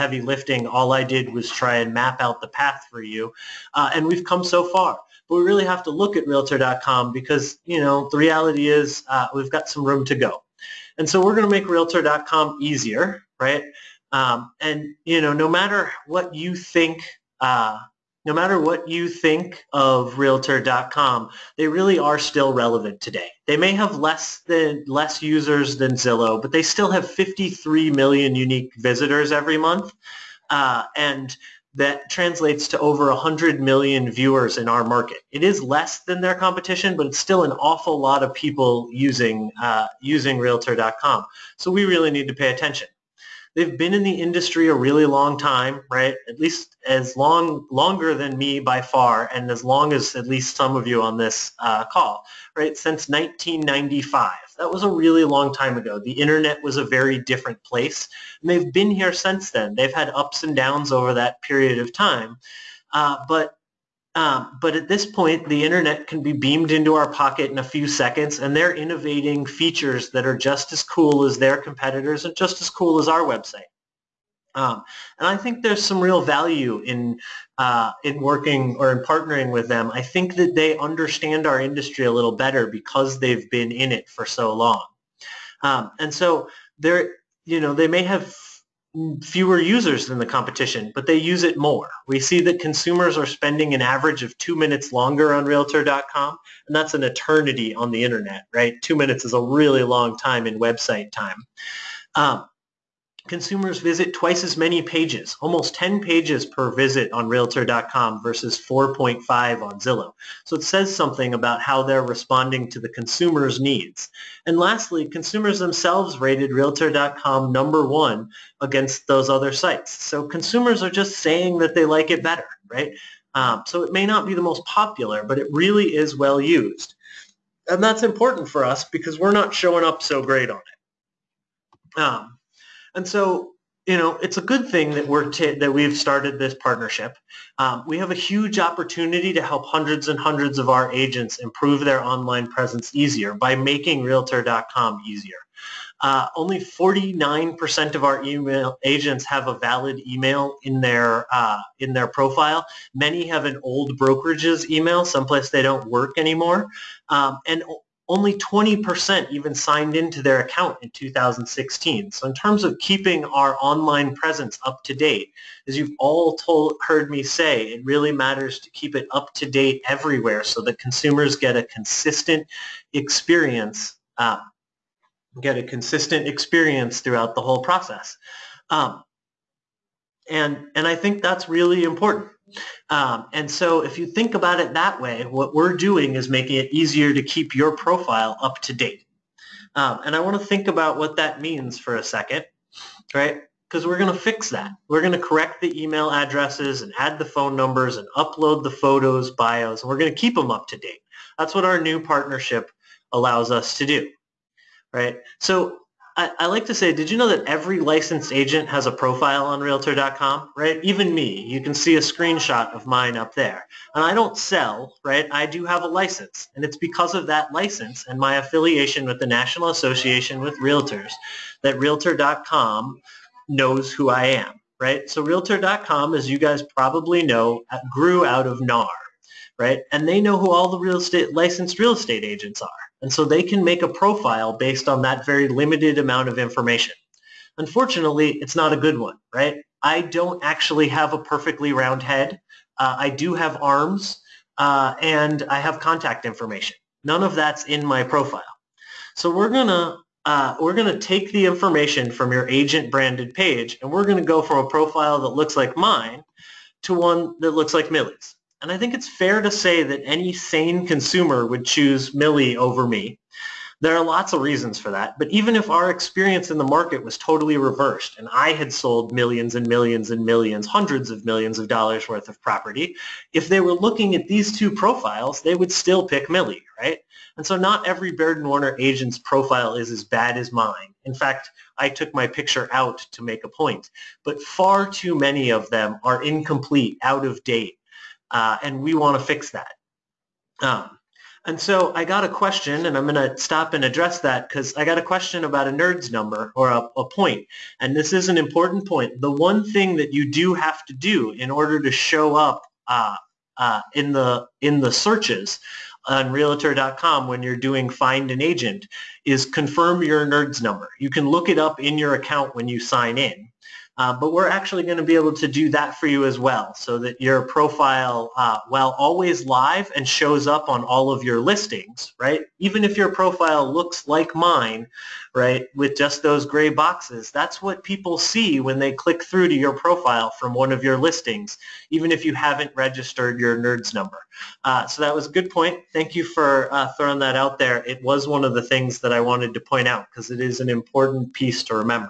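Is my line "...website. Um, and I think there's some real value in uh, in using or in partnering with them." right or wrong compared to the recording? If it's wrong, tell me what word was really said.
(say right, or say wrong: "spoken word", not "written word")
wrong: "working", not "using".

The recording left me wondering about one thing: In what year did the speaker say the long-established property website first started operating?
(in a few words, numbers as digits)
1995.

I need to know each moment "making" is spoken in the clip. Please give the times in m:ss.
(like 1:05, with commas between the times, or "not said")
2:23, 3:06.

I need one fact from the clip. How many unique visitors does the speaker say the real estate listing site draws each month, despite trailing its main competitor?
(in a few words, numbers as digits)
53 million.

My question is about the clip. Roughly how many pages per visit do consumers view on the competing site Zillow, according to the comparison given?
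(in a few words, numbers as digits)
4.5.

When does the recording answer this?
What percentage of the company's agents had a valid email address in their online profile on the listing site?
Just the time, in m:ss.
2:26.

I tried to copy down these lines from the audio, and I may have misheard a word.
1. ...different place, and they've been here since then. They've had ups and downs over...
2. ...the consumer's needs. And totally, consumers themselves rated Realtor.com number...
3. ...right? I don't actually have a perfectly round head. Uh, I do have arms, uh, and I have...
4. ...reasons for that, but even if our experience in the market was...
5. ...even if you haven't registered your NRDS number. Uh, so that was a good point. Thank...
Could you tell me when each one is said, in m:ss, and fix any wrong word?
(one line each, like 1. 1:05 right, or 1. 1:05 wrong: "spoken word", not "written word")
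1. 0:57 right
2. 1:52 wrong: "lastly", not "totally"
3. 3:59 right
4. 4:24 right
5. 5:31 right.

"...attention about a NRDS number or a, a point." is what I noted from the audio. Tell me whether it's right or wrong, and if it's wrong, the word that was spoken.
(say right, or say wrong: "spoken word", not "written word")
wrong: "question", not "attention".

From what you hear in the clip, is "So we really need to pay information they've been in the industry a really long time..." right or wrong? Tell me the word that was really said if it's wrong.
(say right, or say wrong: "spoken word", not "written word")
wrong: "attention", not "information".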